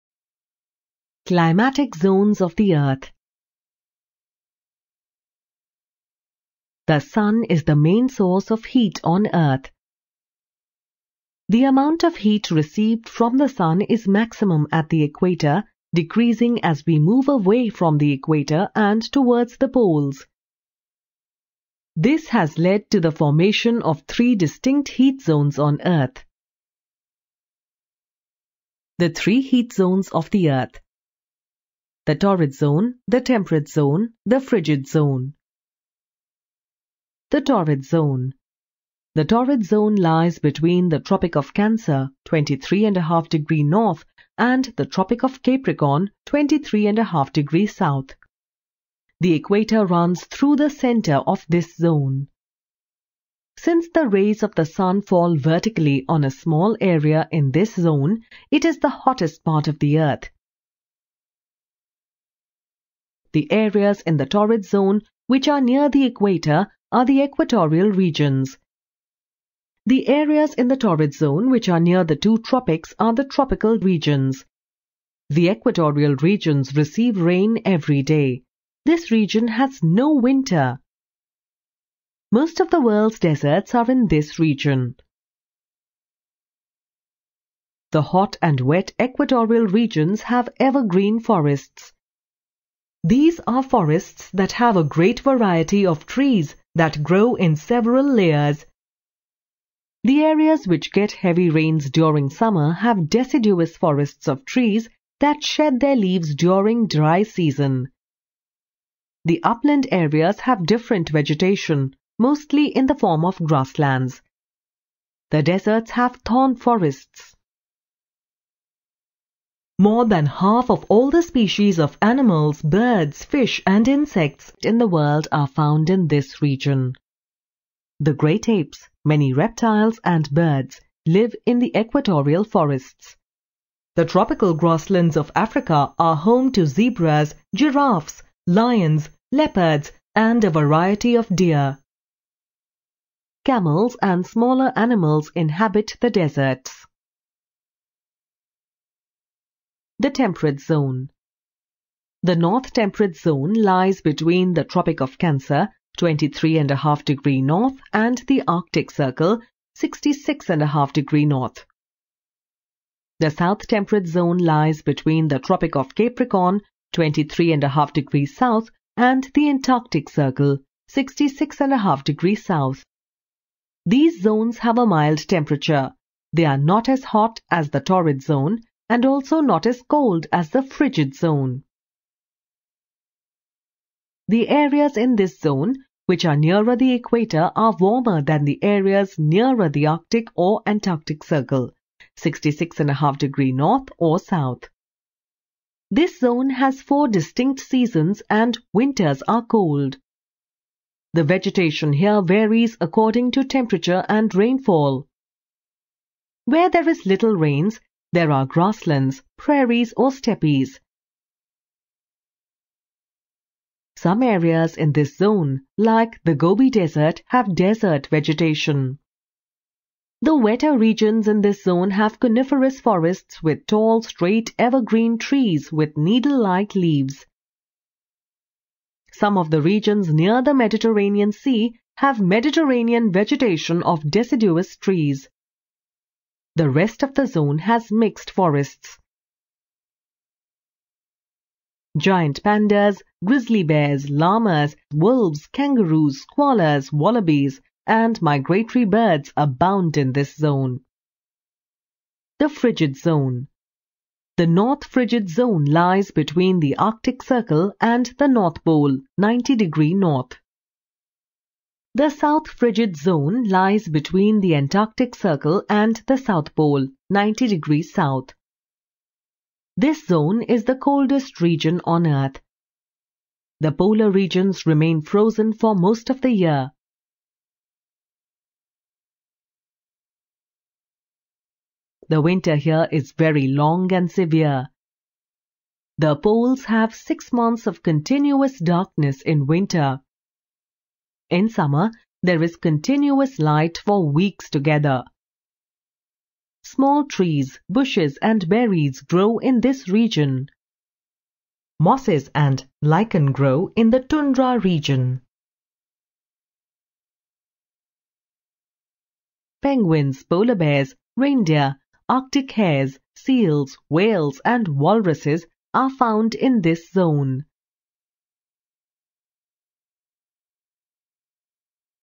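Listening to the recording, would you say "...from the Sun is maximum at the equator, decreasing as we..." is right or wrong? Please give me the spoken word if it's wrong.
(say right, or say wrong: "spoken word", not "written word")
right.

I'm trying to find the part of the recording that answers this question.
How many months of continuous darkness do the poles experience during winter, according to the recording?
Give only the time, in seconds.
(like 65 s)
286 s.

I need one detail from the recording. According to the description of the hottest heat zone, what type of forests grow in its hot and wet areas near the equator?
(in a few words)
evergreen forests.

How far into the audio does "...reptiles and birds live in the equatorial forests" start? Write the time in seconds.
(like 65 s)
129 s.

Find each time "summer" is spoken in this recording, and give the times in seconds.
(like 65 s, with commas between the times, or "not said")
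102 s, 291 s.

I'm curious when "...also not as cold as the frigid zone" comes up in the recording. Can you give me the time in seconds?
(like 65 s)
179 s.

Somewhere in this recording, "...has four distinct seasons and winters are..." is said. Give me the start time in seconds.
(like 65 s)
196 s.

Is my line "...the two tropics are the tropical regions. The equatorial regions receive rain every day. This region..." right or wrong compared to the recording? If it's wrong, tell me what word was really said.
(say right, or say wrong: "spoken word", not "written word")
right.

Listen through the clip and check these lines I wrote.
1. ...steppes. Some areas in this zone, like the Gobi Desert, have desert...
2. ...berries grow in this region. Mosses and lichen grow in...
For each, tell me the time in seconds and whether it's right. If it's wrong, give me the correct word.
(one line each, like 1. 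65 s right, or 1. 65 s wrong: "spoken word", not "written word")
1. 210 s right
2. 298 s right.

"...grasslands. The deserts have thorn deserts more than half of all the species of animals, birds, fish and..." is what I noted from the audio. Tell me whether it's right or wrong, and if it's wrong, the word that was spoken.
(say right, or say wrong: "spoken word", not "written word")
wrong: "forests", not "deserts".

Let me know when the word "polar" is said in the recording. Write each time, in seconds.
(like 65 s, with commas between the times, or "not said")
273 s, 310 s.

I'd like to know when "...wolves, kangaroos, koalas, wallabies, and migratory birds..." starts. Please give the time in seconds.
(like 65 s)
244 s.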